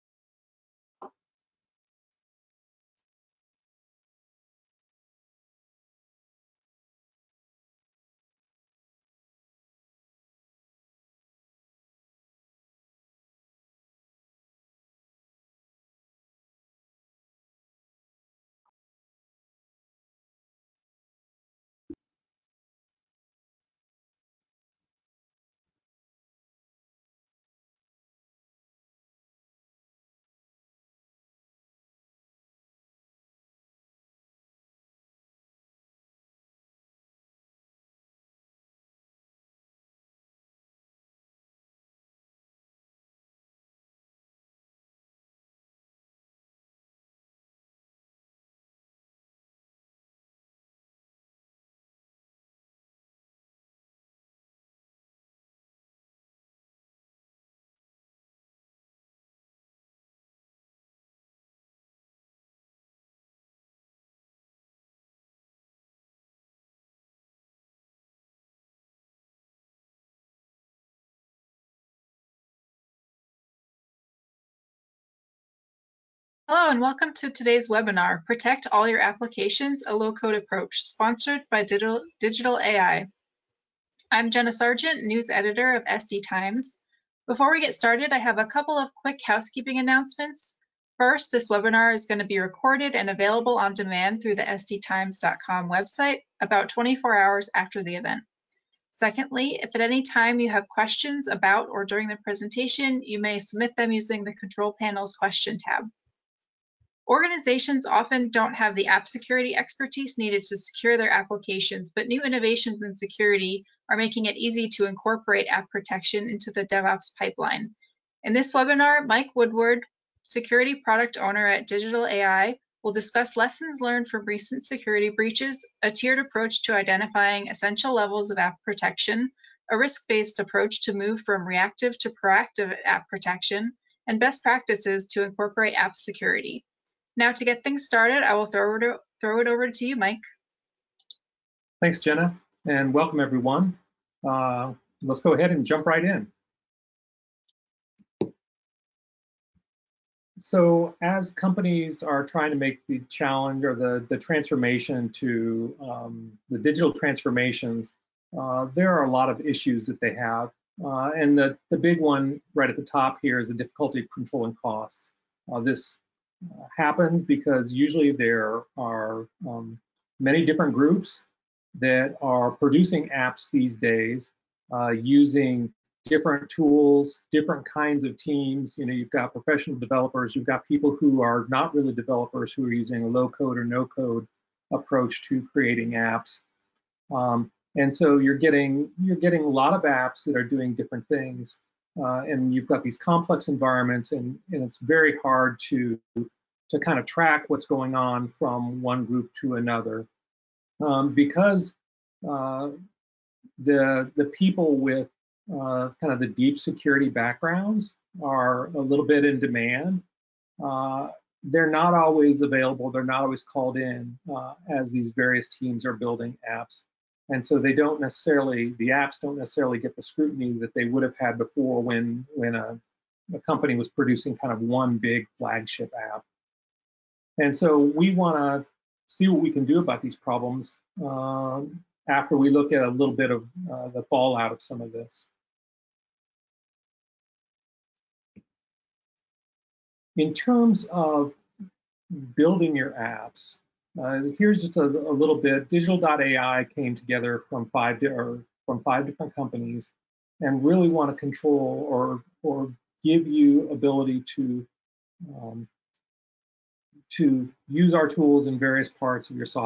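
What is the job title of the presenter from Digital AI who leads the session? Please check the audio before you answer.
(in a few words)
Security Product Owner.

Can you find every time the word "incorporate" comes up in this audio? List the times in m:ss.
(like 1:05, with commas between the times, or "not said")
1:54, 2:15.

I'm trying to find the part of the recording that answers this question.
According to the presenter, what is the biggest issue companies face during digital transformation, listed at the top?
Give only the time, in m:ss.
2:44.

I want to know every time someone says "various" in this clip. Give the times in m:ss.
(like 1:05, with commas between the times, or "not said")
3:35, 4:18.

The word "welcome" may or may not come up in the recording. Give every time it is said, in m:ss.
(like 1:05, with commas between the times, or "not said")
1:16, 2:22.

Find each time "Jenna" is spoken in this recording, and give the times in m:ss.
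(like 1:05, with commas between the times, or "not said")
1:24, 2:21.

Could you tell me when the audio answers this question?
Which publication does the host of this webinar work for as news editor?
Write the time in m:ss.
1:25.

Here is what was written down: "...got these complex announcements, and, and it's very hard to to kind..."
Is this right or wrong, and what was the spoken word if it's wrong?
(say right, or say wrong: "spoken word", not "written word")
wrong: "environments", not "announcements".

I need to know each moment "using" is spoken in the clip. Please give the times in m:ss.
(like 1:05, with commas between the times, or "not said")
1:43, 2:54, 3:02.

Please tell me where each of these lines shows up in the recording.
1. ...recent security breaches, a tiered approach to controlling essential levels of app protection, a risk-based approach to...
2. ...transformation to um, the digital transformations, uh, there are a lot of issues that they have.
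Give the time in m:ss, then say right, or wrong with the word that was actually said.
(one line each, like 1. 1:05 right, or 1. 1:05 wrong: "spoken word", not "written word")
1. 2:04 wrong: "identifying", not "controlling"
2. 2:34 right.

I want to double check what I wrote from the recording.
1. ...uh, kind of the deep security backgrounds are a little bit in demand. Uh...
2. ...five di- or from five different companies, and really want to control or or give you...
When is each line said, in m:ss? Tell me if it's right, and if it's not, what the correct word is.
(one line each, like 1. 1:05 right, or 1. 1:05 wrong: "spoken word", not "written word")
1. 3:25 right
2. 4:07 right.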